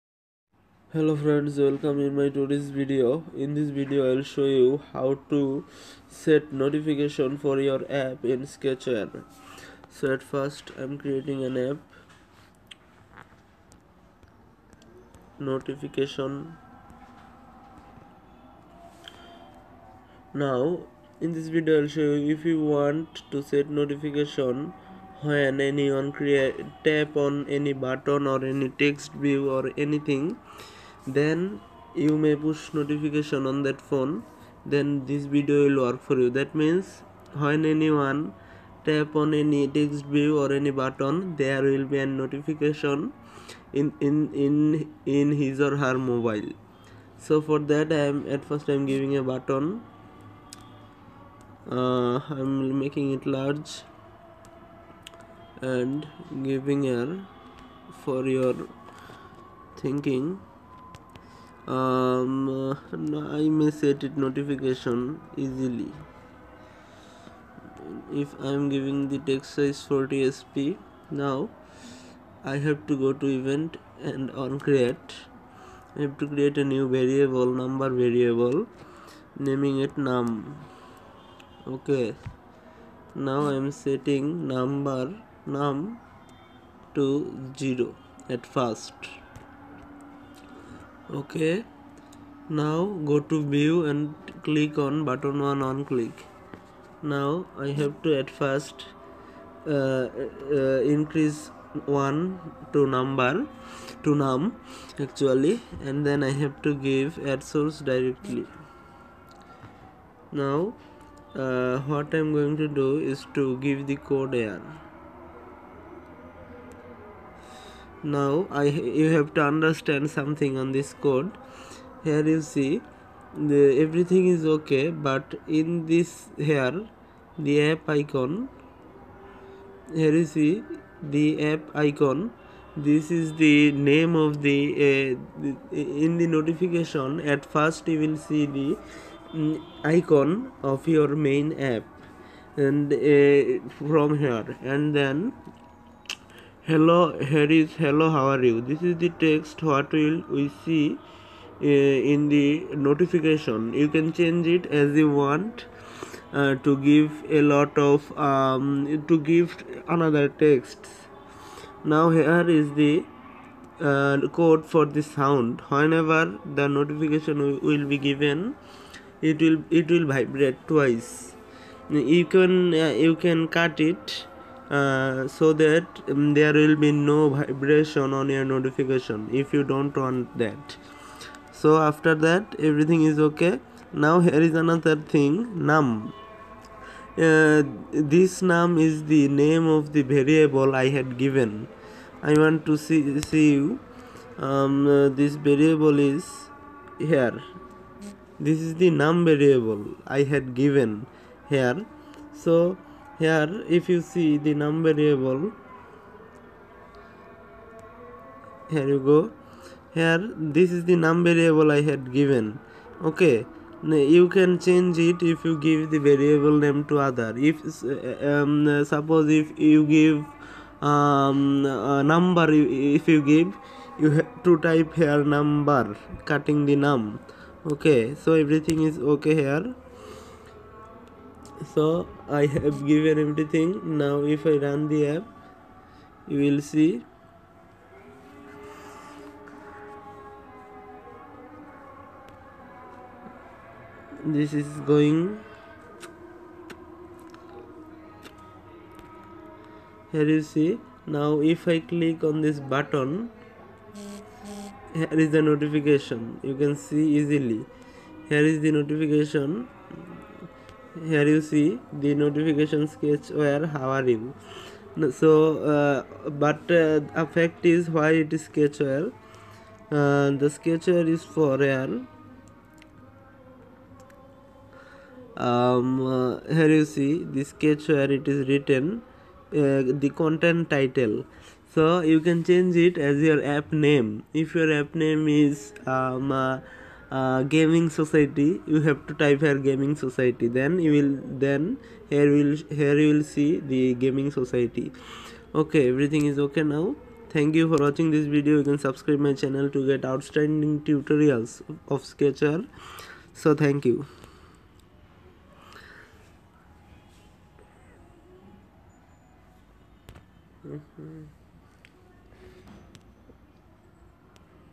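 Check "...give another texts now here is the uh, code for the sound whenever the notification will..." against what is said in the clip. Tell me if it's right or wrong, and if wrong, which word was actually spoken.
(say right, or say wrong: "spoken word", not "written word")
right.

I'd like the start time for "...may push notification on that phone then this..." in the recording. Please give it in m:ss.
0:32.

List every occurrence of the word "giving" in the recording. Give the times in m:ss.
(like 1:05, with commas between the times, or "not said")
0:48, 0:56, 1:08.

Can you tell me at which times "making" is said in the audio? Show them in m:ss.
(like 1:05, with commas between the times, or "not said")
0:52.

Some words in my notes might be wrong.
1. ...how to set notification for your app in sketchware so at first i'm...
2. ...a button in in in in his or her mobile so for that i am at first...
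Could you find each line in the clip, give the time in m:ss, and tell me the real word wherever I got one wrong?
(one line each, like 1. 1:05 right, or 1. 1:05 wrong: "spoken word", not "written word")
1. 0:04 right
2. 0:41 wrong: "notification", not "button".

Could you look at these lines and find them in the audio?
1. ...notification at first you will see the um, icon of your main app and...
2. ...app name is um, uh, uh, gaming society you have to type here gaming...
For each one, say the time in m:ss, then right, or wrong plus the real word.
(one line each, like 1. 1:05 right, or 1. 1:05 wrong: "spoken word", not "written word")
1. 2:16 right
2. 4:44 right.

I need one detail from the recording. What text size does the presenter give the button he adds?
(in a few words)
40 sp.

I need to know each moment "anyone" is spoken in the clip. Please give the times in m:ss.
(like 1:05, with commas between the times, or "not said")
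0:25, 0:37.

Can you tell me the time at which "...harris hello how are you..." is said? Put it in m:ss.
2:27.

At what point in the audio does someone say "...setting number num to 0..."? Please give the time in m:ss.
1:23.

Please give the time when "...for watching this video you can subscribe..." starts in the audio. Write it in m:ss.
4:57.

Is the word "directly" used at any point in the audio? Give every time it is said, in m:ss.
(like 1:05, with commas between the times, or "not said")
1:47.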